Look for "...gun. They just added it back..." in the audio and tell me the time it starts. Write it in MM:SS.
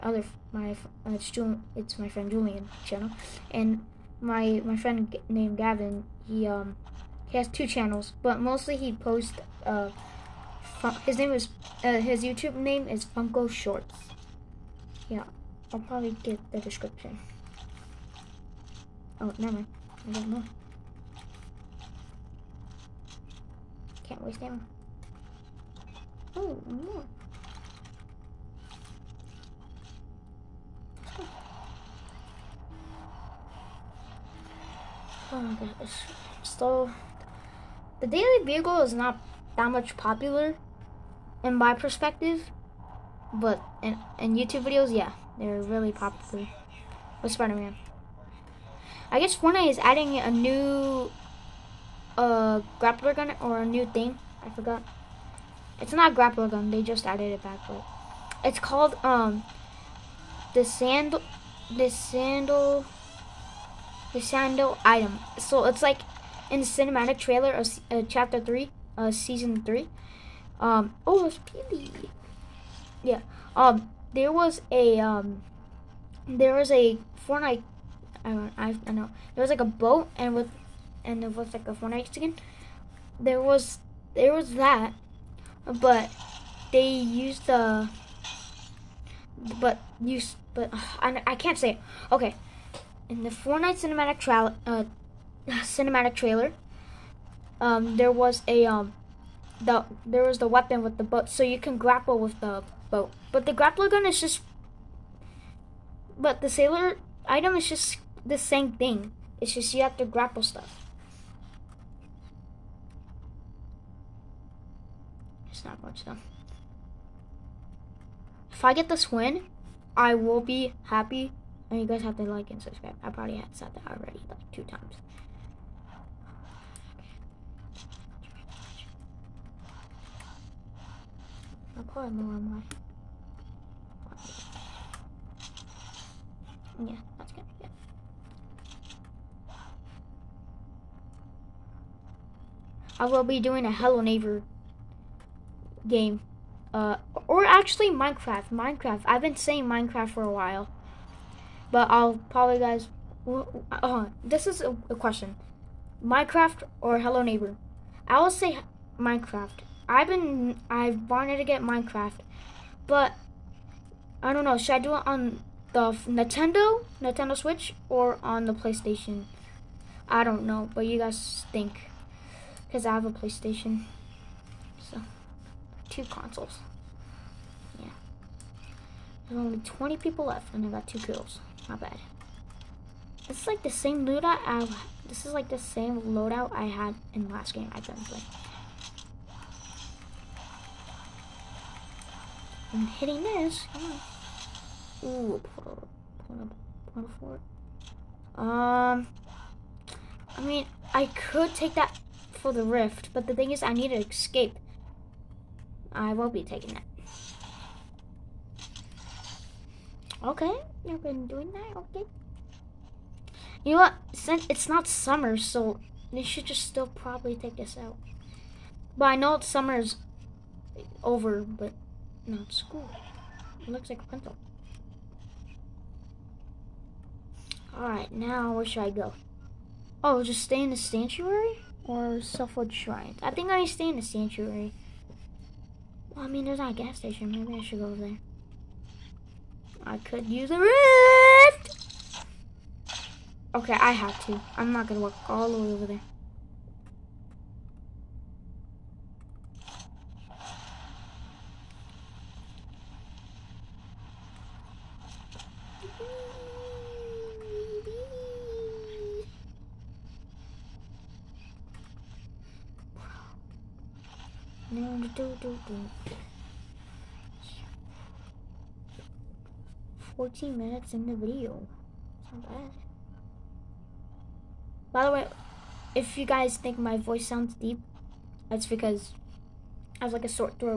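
00:56.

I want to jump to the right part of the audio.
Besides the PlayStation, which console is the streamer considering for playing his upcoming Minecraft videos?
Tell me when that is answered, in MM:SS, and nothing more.
02:47.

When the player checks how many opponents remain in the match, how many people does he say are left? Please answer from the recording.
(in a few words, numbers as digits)
20.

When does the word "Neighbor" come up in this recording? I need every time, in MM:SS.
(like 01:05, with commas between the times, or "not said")
02:24, 02:37.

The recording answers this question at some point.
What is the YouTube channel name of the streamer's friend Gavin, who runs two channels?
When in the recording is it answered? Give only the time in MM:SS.
00:13.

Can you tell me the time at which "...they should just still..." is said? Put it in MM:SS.
03:36.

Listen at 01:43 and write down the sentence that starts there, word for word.
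But the grappler gun is just, but the sailor item is just the same thing.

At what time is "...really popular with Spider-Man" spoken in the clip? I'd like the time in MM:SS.
00:45.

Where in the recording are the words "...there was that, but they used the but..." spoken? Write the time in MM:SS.
01:24.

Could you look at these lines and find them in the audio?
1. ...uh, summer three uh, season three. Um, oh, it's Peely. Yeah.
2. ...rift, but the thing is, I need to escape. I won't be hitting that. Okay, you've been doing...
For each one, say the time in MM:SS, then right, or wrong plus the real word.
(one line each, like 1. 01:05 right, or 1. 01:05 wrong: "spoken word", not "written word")
1. 01:07 wrong: "chapter", not "summer"
2. 03:22 wrong: "taking", not "hitting".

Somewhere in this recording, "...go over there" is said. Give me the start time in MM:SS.
03:57.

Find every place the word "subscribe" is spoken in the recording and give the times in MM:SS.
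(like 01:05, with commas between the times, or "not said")
02:02.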